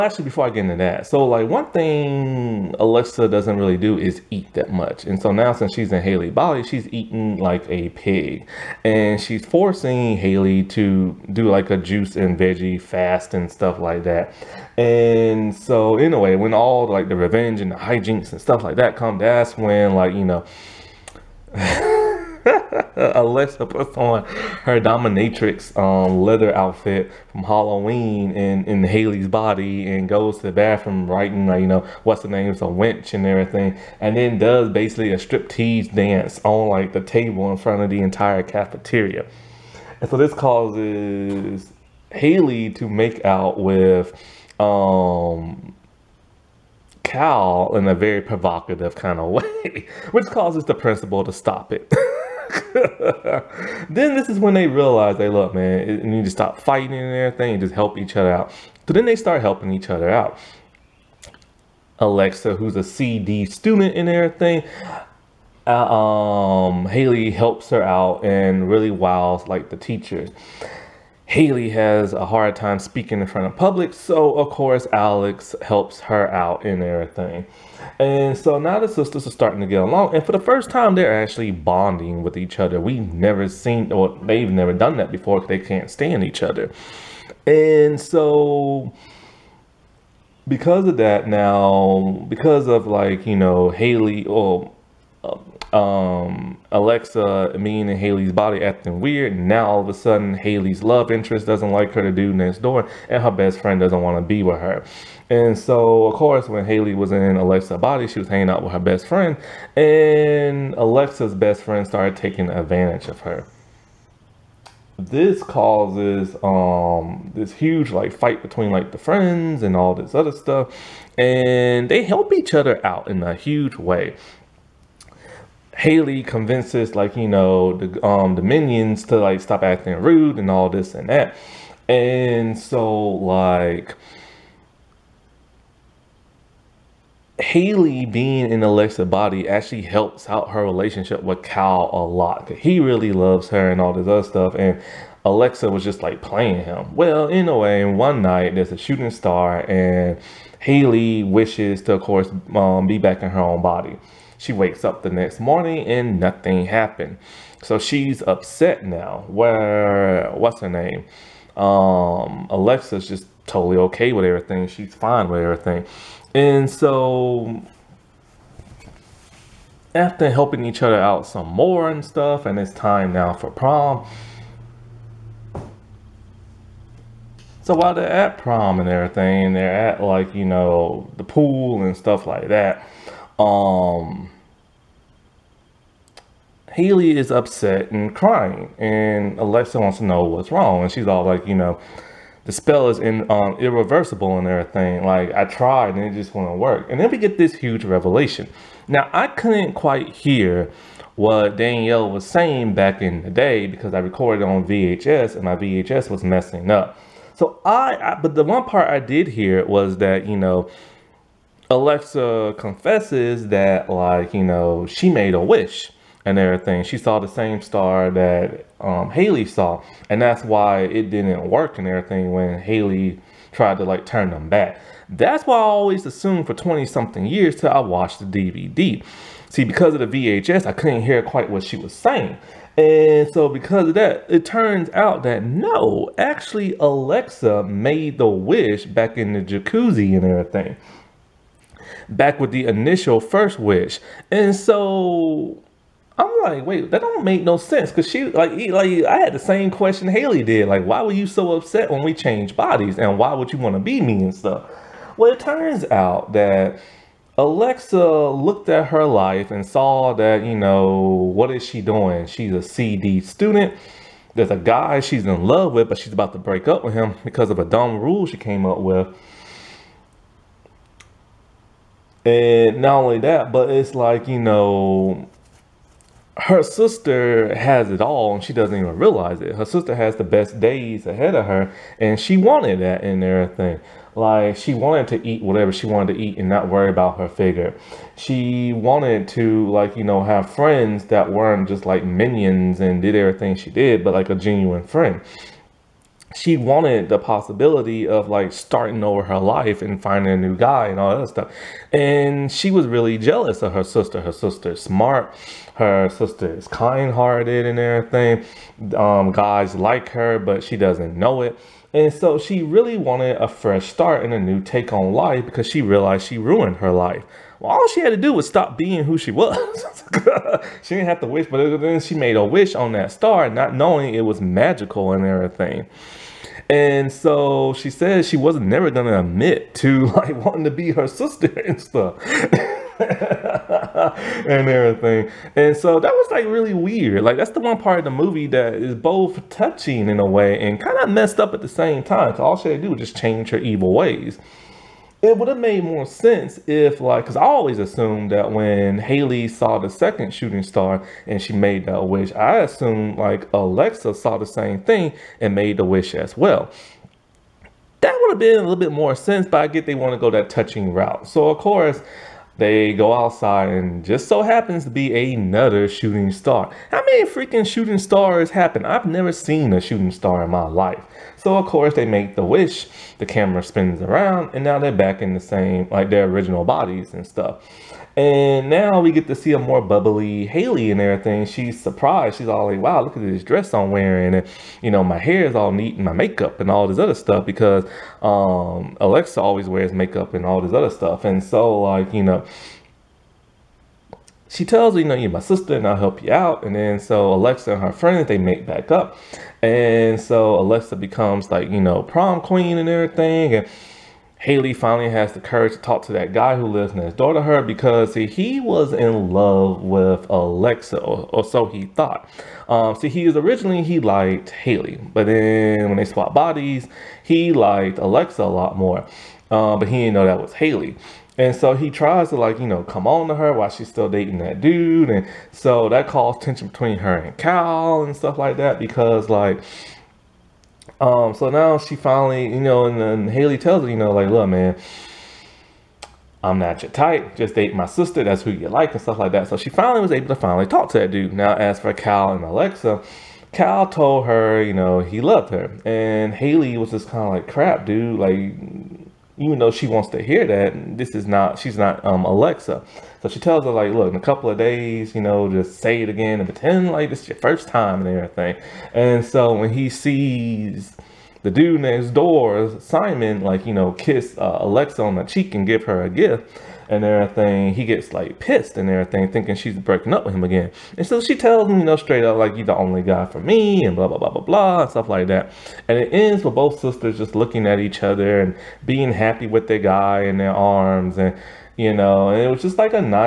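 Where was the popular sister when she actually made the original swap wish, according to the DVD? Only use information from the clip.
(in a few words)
the jacuzzi.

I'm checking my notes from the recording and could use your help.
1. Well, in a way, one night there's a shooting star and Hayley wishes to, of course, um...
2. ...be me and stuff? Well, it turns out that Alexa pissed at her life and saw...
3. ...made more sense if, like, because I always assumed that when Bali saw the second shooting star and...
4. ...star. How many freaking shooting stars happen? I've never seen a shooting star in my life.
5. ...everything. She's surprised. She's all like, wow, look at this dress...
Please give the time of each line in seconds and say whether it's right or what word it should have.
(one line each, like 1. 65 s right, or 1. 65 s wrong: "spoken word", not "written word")
1. 146 s right
2. 253 s wrong: "looked", not "pissed"
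3. 345 s wrong: "Hayley", not "Bali"
4. 366 s right
5. 381 s right.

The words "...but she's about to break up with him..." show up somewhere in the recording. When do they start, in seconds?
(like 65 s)
265 s.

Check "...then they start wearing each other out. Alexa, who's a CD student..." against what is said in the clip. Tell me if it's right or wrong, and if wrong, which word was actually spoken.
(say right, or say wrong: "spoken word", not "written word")
wrong: "helping", not "wearing".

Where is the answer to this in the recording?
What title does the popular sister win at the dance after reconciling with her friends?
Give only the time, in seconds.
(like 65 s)
402 s.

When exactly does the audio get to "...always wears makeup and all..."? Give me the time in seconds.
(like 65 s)
389 s.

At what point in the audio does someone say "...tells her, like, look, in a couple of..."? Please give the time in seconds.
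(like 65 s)
453 s.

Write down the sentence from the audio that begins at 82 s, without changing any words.
We've never seen, or they've never done that before because they can't stand each other.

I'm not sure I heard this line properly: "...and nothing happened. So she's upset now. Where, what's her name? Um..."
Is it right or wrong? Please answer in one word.
right.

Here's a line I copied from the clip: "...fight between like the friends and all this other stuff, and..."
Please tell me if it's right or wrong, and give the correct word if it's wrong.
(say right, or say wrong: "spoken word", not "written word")
right.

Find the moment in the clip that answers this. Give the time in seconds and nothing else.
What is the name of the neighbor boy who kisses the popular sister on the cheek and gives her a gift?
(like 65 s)
462 s.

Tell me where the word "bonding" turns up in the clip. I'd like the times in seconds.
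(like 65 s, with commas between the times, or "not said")
81 s.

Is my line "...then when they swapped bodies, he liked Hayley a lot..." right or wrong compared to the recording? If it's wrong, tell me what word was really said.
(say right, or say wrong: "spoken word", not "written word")
wrong: "Alexa", not "Hayley".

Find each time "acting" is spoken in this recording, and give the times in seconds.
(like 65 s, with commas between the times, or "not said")
98 s, 129 s.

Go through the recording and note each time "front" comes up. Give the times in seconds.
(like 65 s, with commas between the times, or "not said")
37 s, 73 s.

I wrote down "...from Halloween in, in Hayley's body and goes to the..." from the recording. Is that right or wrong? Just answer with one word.
right.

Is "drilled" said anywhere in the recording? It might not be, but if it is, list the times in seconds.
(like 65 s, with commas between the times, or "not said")
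not said.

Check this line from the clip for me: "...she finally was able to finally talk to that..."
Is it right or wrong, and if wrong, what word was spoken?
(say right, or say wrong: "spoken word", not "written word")
right.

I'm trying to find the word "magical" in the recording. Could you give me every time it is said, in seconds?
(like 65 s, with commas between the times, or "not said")
324 s.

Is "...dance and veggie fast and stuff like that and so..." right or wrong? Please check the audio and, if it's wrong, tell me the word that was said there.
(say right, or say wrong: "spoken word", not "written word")
wrong: "juice", not "dance".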